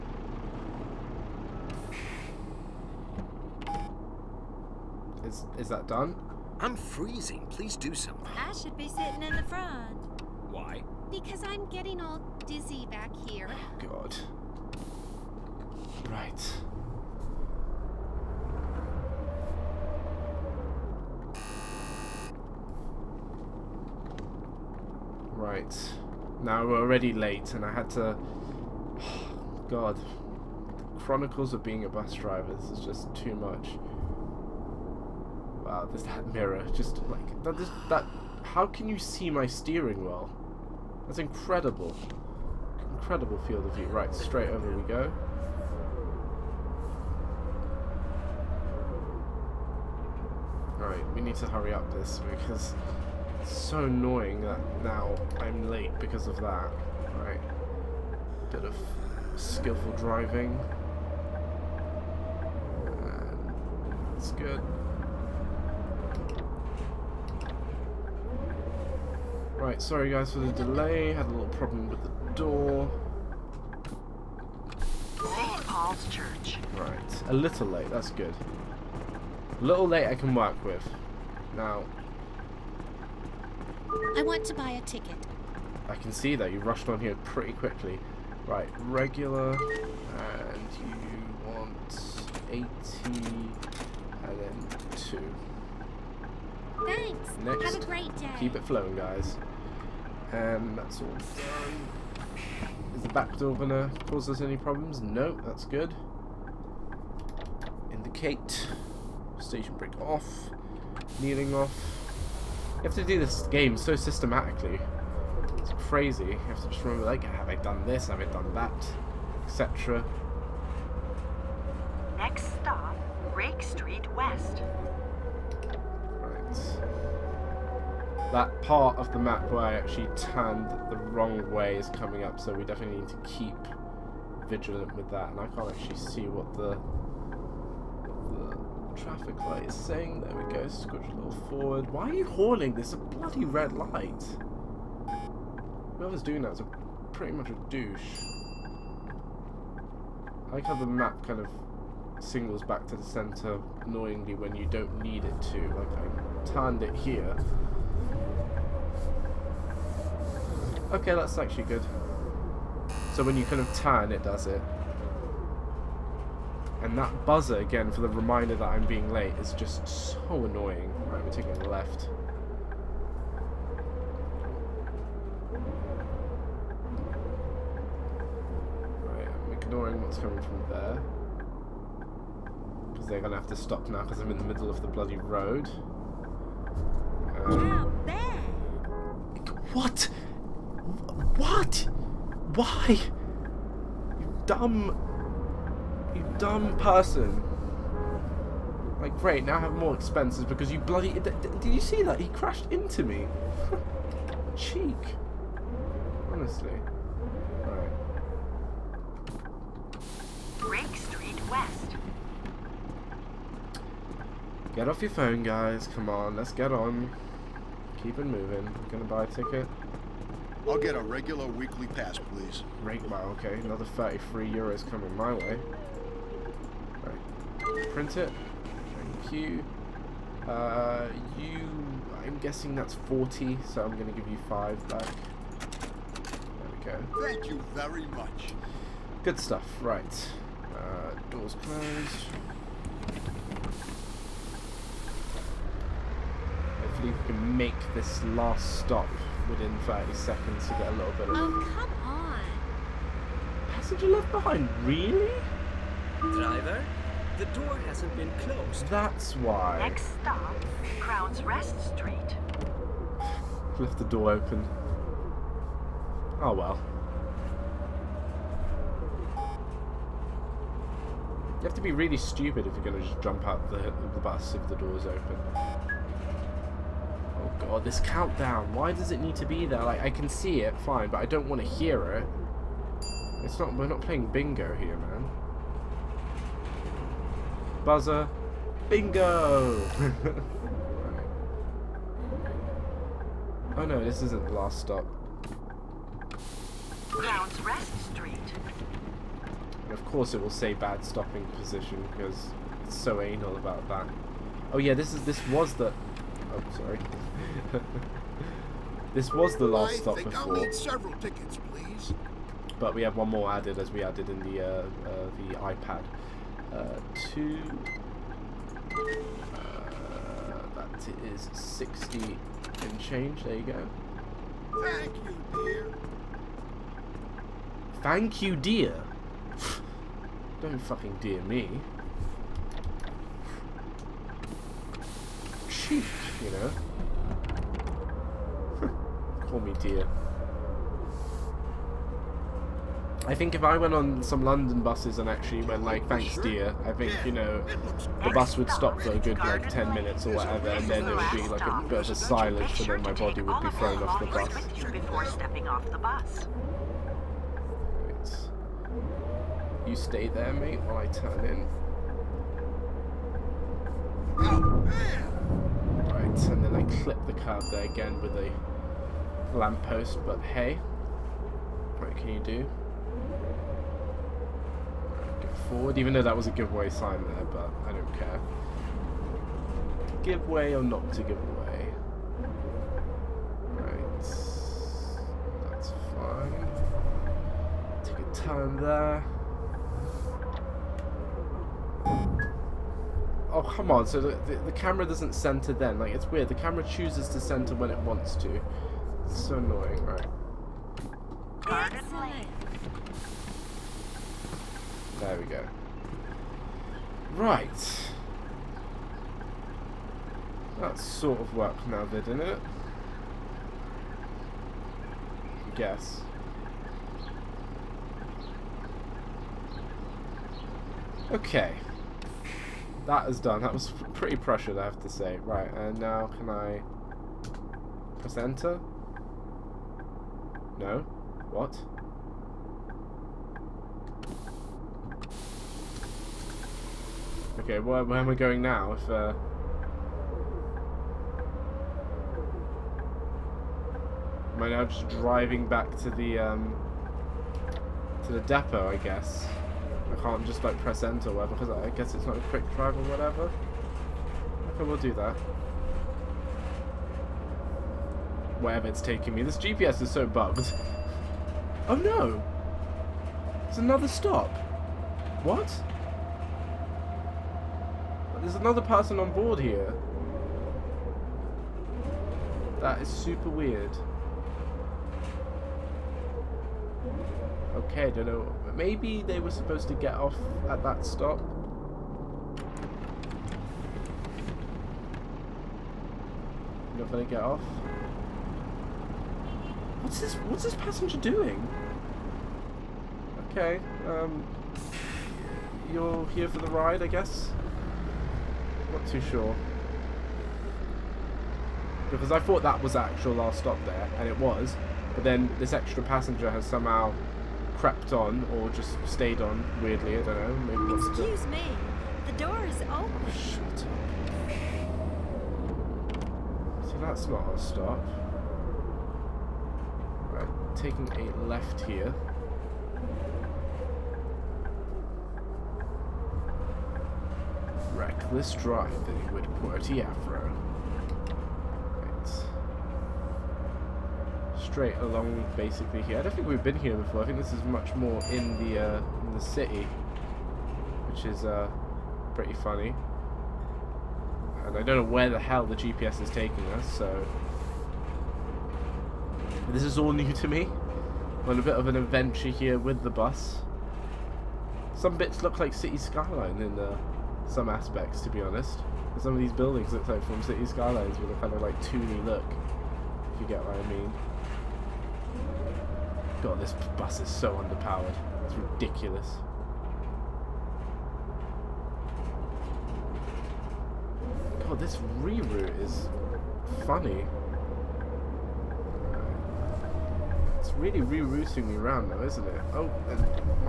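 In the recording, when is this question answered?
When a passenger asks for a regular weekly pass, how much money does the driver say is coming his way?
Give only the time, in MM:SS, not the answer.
03:43.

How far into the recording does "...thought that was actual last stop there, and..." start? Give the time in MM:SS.
08:22.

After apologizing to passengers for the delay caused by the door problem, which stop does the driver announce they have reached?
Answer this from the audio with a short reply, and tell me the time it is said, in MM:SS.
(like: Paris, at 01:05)
St. Paul's Church, at 01:15.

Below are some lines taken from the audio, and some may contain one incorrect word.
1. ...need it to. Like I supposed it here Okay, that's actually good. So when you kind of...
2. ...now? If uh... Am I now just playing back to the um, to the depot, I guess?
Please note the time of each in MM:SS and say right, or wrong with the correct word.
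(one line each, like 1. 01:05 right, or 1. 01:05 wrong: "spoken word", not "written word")
1. 02:34 wrong: "turned", not "supposed"
2. 07:18 wrong: "driving", not "playing".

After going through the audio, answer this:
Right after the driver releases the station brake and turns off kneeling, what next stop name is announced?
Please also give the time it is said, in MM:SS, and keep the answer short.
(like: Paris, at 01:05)
Rake Street West, at 02:03.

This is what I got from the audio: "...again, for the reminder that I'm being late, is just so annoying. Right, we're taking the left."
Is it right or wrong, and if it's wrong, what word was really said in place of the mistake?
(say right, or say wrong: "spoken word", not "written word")
right.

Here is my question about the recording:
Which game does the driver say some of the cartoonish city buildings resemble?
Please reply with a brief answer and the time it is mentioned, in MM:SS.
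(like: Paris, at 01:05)
City Skylines, at 09:20.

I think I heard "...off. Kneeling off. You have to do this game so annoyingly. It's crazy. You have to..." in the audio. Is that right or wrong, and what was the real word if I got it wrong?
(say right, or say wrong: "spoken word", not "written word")
wrong: "systematically", not "annoyingly".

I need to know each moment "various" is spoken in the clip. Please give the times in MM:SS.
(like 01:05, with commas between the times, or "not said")
not said.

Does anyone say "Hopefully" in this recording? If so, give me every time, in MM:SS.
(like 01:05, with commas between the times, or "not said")
04:06.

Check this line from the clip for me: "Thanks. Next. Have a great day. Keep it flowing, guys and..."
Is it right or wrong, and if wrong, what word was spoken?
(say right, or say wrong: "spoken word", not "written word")
right.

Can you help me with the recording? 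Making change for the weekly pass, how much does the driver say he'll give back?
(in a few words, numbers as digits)
5.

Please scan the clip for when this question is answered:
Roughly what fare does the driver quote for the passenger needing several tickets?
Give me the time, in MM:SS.
05:21.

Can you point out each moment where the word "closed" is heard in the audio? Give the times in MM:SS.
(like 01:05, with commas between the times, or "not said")
04:01, 04:18.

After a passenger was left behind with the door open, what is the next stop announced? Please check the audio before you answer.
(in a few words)
Crown's Rest Street.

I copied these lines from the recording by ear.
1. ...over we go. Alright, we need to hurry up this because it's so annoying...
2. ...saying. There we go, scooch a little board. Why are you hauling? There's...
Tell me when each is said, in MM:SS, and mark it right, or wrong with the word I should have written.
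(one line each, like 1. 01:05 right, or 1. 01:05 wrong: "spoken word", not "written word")
1. 00:44 right
2. 02:19 wrong: "forward", not "board".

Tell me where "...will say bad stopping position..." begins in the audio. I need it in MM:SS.
05:00.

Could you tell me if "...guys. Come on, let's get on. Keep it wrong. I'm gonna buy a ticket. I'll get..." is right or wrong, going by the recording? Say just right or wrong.
wrong.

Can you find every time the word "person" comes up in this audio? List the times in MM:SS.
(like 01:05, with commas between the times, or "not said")
03:16, 07:48.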